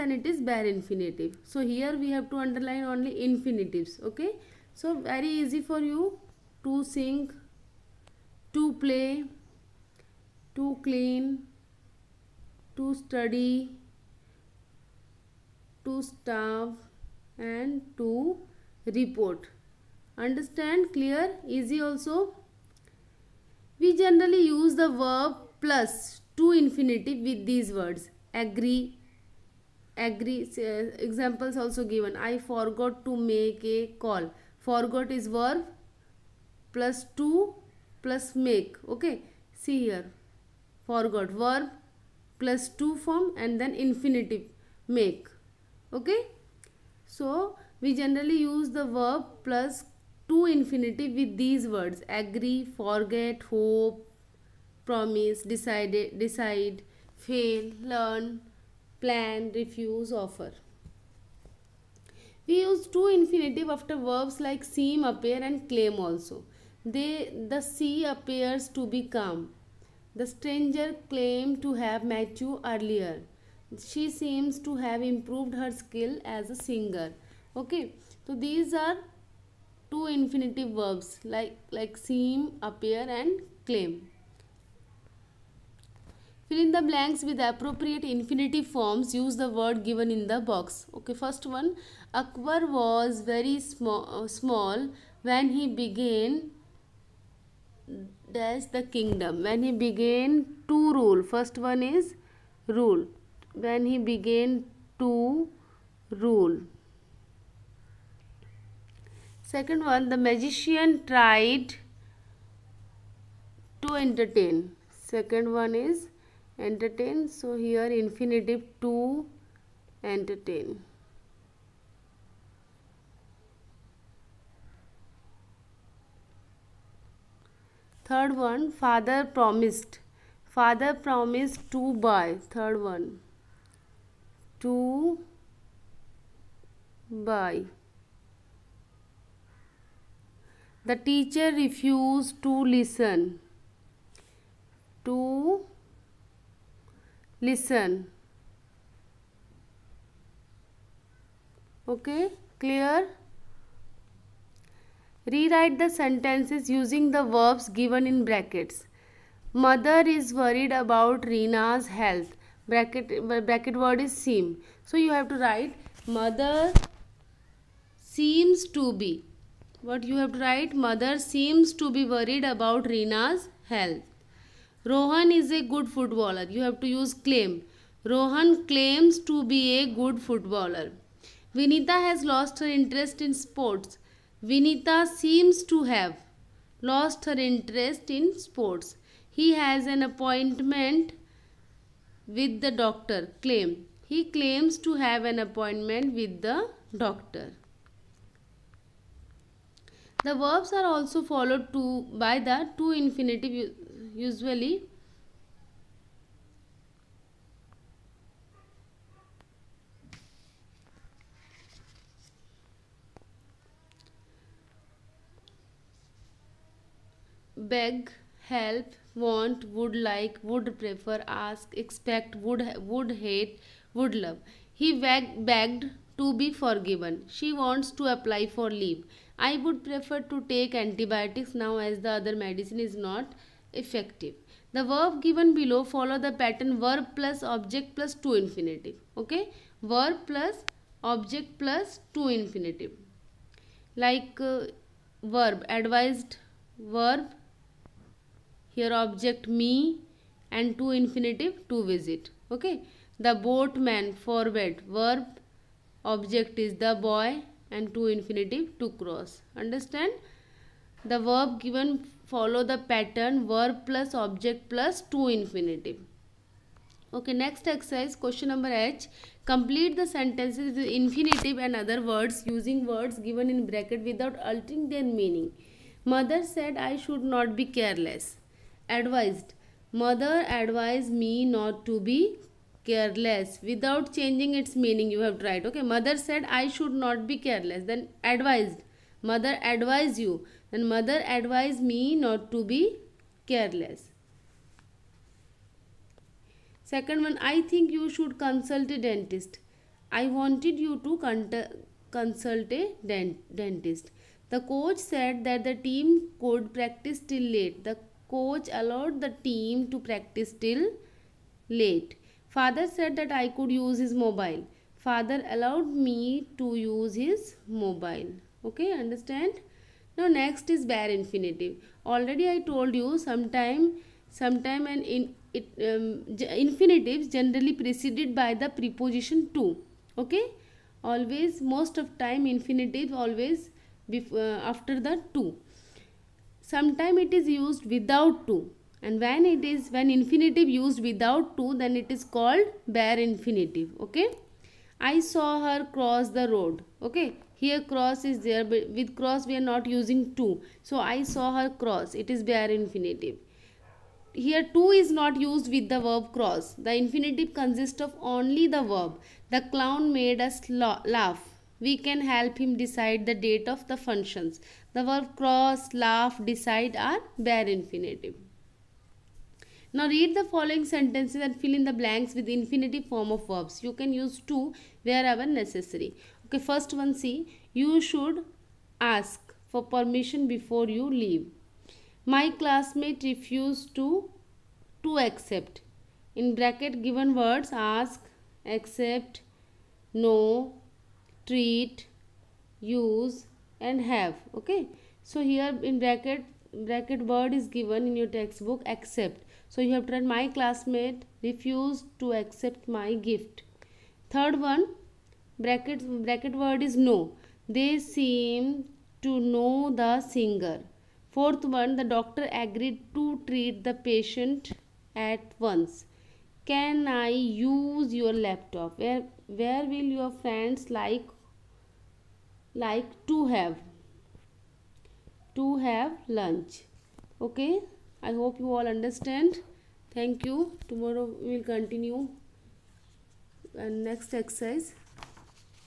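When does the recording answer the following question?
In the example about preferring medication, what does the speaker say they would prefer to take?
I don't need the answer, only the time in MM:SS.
03:50.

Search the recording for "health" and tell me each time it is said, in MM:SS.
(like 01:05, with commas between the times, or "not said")
02:41, 02:53.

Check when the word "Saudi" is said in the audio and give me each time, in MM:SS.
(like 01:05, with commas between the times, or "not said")
not said.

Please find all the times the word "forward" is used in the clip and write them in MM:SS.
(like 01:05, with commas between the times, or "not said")
04:14.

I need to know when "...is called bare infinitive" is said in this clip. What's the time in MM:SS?
05:42.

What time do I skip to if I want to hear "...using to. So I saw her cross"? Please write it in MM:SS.
05:49.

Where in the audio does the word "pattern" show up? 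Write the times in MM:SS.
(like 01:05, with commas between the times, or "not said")
03:56, 04:22.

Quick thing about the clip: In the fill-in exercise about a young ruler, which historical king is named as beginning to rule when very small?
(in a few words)
Akbar.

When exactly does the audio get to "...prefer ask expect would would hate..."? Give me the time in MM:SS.
03:40.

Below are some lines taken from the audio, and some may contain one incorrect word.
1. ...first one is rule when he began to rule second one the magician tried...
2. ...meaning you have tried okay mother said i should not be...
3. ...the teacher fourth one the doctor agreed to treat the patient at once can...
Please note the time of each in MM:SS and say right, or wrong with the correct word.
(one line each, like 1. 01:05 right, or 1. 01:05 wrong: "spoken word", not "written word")
1. 01:41 right
2. 04:44 right
3. 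06:50 wrong: "singer", not "teacher".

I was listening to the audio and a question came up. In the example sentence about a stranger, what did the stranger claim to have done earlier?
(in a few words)
met you.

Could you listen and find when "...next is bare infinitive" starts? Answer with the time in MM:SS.
05:20.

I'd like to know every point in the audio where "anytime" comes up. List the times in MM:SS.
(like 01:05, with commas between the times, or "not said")
not said.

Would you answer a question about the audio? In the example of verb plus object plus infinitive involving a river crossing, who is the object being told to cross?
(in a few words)
the boy.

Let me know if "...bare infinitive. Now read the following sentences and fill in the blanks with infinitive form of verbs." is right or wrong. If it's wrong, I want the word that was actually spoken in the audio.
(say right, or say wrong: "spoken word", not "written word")
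right.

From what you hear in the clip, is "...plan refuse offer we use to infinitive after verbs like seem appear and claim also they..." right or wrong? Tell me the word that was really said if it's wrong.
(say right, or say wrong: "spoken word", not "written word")
right.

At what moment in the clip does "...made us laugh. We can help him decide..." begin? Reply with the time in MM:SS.
06:00.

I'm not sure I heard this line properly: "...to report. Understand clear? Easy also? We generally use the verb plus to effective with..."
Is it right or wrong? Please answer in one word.
wrong.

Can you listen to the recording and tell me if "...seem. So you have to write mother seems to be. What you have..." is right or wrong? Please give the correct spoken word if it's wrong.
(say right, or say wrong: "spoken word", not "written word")
right.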